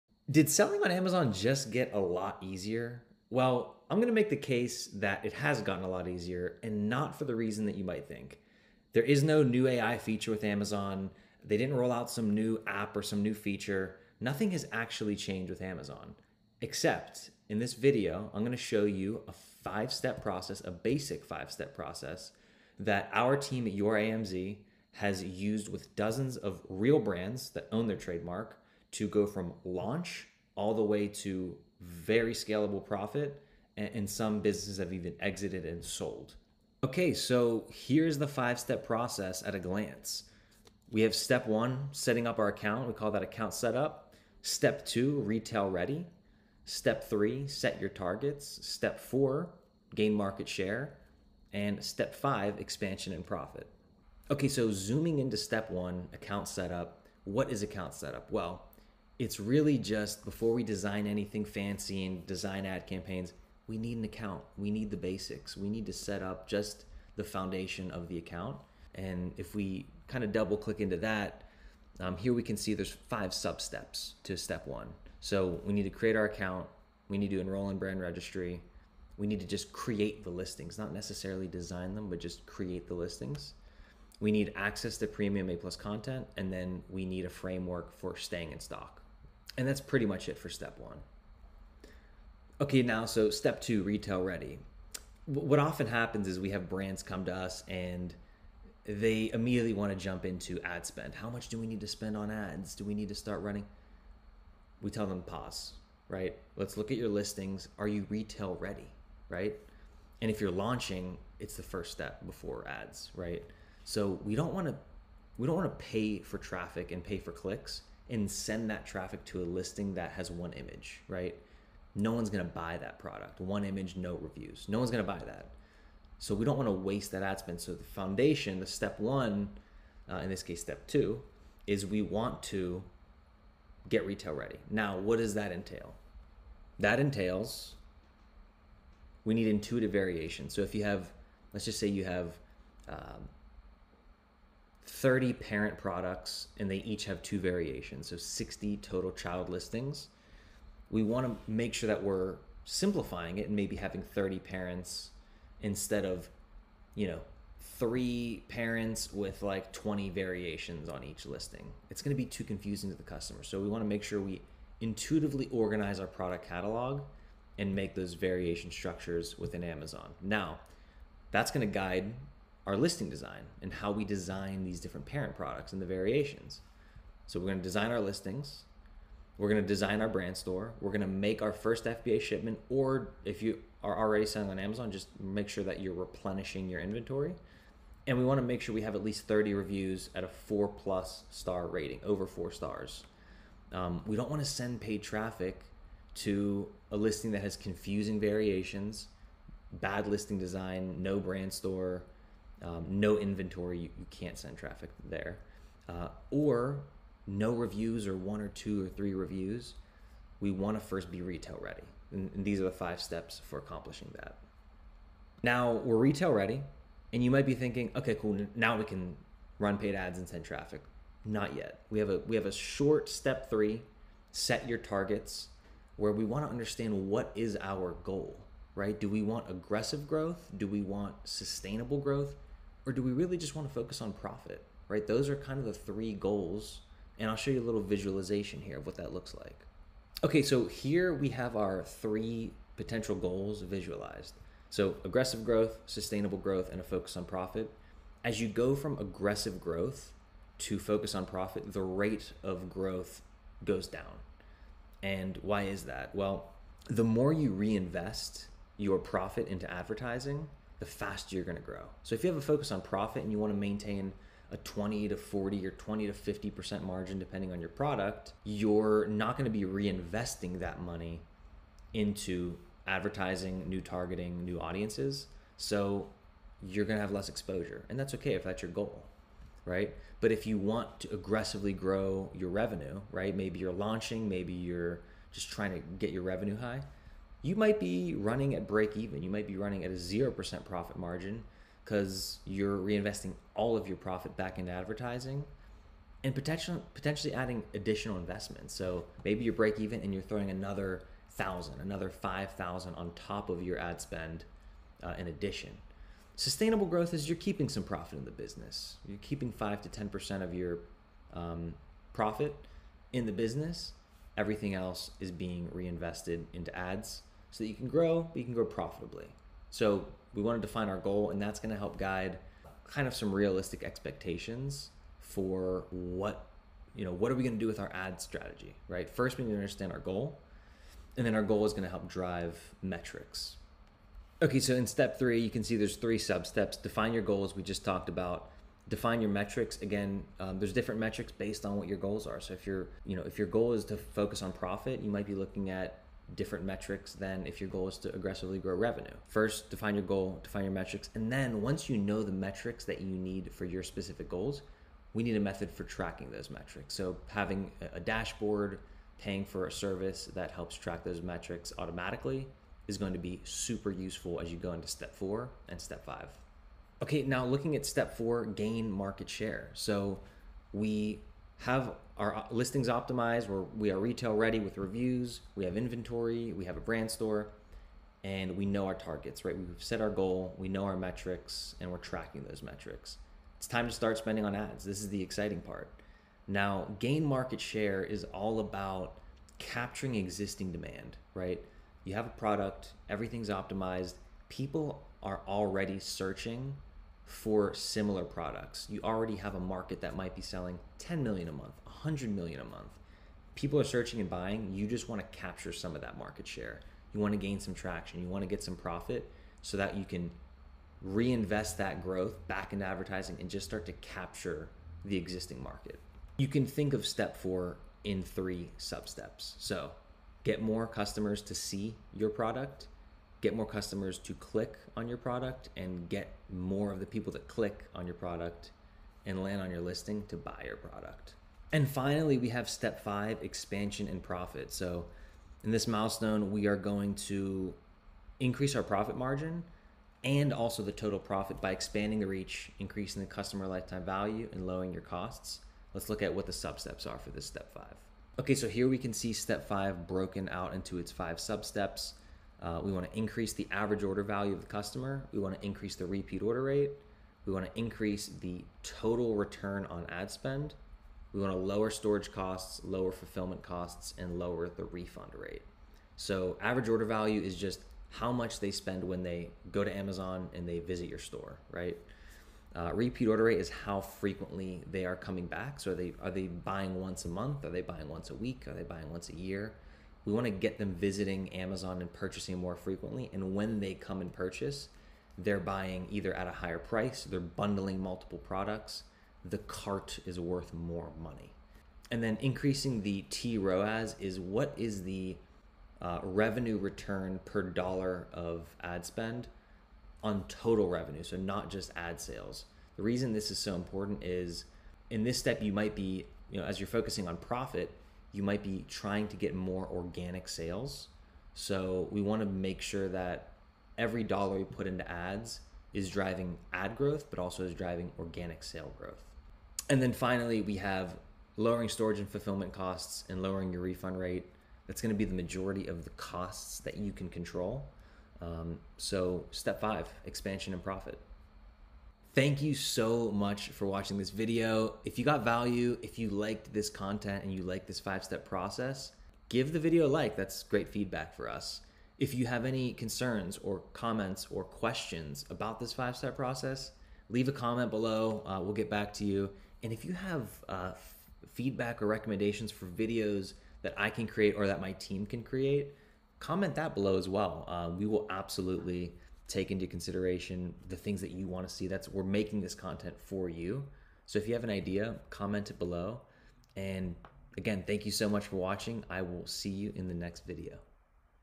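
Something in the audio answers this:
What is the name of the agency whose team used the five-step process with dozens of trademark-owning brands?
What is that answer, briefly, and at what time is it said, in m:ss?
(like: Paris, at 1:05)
Your AMZ, at 0:23.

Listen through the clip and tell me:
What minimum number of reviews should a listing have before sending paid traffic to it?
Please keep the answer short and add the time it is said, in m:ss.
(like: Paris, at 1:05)
30, at 3:08.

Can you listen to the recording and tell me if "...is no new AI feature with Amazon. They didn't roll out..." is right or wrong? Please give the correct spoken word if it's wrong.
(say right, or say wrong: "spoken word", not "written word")
right.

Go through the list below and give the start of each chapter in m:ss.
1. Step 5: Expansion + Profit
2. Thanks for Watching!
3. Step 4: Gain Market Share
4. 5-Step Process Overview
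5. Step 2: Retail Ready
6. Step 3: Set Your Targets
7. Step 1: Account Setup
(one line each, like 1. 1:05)
1. 7:11
2. 8:53
3. 6:07
4. 0:36
5. 1:32
6. 3:35
7. 0:53.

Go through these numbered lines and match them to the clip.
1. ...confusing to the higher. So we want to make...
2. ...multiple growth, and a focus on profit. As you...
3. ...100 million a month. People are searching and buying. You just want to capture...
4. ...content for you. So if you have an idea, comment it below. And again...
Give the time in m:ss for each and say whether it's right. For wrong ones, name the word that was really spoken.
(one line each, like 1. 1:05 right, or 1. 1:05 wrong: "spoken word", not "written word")
1. 2:42 wrong: "customer", not "higher"
2. 4:05 wrong: "sustainable", not "multiple"
3. 6:41 right
4. 9:22 right.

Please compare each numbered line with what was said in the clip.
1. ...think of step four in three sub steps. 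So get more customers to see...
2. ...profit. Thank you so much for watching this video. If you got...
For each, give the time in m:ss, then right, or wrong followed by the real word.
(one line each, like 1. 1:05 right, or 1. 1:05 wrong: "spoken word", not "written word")
1. 6:56 right
2. 8:50 right.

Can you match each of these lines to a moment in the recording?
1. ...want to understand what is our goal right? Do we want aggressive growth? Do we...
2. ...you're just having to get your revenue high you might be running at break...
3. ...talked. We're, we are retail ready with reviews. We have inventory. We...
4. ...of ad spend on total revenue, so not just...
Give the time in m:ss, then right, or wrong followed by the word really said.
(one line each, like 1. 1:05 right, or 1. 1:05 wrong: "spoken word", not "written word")
1. 3:46 right
2. 4:44 wrong: "trying", not "having"
3. 6:12 wrong: "optimized", not "talked"
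4. 8:18 right.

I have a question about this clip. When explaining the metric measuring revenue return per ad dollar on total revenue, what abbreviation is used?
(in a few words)
TROAS.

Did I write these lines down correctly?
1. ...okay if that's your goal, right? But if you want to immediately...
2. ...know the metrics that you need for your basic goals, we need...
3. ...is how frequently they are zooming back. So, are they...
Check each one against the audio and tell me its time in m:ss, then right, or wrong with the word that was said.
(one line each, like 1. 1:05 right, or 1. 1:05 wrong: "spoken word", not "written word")
1. 4:38 wrong: "aggressively", not "immediately"
2. 5:51 wrong: "specific", not "basic"
3. 7:53 wrong: "coming", not "zooming".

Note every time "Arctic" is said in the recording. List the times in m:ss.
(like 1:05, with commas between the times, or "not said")
not said.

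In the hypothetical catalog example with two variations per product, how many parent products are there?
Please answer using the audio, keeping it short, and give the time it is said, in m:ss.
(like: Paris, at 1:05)
30, at 2:24.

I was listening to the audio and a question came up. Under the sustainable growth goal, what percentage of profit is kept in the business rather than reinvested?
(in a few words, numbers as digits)
5 to 10%.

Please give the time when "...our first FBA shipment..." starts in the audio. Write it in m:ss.
3:01.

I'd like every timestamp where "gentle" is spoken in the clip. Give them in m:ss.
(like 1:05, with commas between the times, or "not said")
not said.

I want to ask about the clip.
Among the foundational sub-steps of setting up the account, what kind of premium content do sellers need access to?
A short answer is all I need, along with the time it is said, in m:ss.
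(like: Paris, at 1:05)
A plus content, at 1:25.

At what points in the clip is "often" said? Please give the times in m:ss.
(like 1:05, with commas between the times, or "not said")
1:35.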